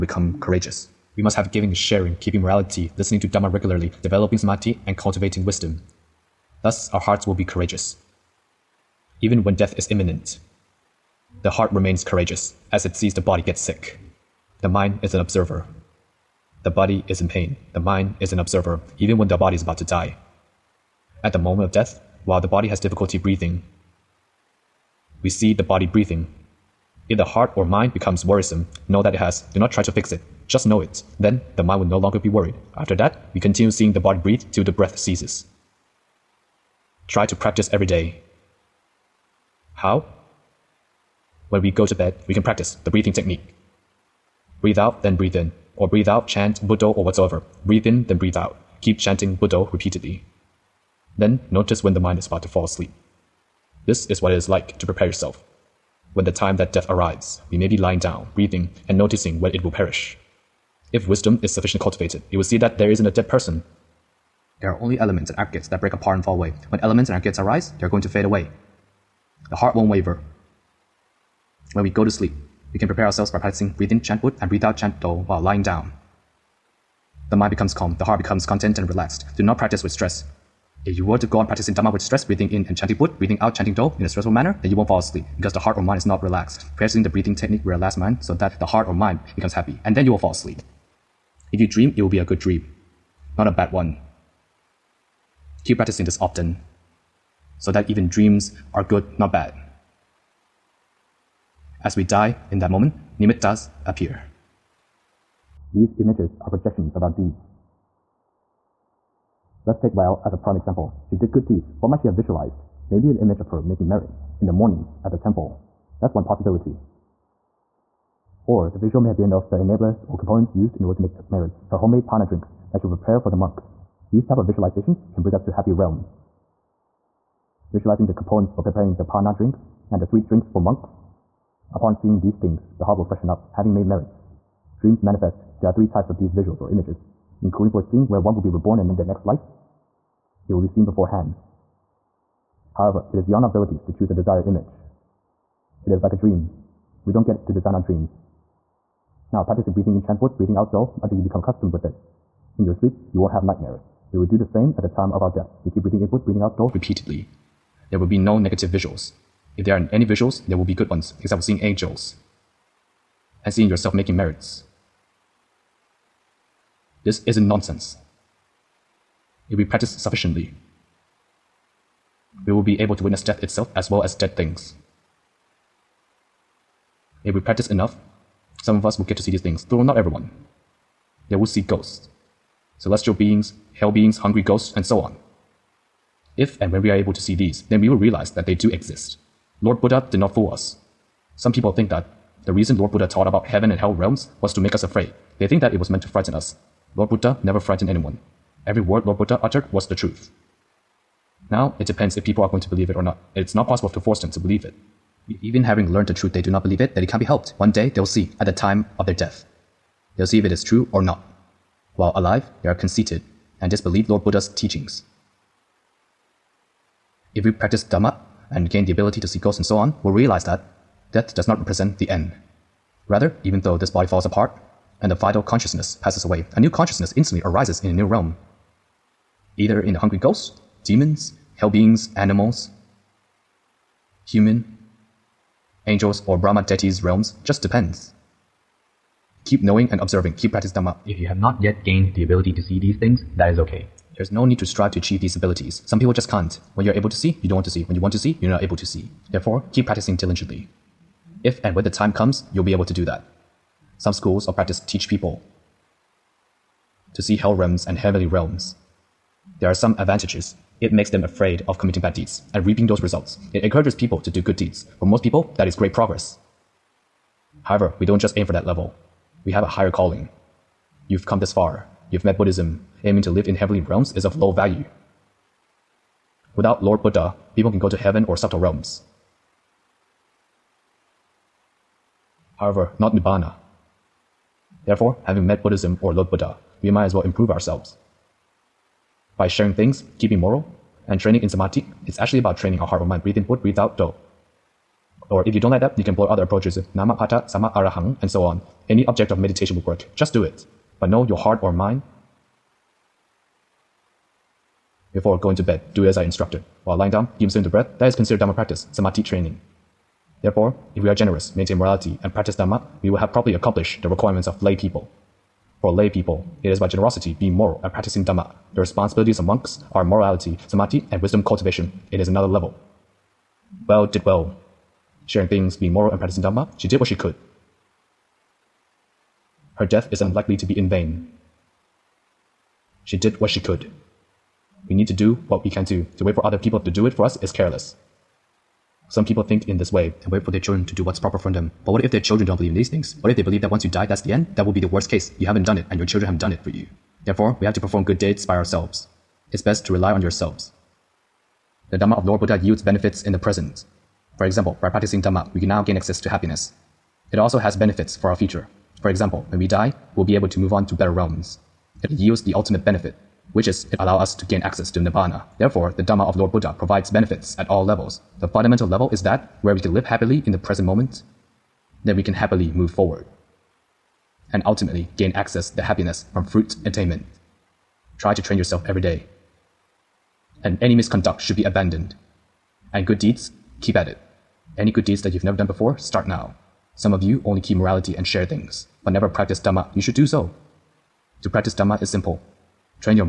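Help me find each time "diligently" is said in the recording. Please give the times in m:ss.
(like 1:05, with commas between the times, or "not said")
4:10.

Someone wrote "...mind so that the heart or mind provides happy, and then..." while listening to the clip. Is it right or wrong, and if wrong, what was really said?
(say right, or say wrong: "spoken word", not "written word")
wrong: "becomes", not "provides".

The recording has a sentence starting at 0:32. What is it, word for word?
After that, we continue seeing the body breathe till the breath ceases.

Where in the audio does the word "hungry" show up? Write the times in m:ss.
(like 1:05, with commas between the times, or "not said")
3:04, 3:49.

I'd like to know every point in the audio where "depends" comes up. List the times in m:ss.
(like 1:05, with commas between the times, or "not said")
3:21, 3:57.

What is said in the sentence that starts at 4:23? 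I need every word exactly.
It encourages people to do good deeds.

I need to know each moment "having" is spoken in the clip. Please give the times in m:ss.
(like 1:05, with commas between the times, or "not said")
2:13, 3:25, 4:45.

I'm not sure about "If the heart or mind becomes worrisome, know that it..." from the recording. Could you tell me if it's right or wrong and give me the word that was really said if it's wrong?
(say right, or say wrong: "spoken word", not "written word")
right.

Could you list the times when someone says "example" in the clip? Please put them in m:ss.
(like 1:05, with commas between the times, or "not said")
1:50, 5:54, 5:59.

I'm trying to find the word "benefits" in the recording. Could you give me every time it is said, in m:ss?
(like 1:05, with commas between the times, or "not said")
5:52, 5:57, 6:02, 6:07.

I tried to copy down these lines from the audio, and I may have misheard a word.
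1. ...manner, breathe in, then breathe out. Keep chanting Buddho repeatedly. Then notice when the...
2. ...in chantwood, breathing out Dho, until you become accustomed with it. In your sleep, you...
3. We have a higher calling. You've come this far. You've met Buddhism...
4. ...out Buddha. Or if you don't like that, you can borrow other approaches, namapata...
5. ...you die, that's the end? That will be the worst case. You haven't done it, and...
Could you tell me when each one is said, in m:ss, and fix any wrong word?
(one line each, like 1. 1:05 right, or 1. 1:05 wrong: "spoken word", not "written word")
1. 0:47 wrong: "whatsoever", not "manner"
2. 2:29 right
3. 4:29 right
4. 4:53 wrong: "Dho", not "Buddha"
5. 5:43 right.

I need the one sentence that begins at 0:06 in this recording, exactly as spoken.
Thus our hearts will be courageous, even when death is imminent.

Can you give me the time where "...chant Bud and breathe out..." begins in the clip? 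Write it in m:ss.
1:14.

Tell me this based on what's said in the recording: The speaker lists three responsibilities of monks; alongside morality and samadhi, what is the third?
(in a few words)
wisdom cultivation.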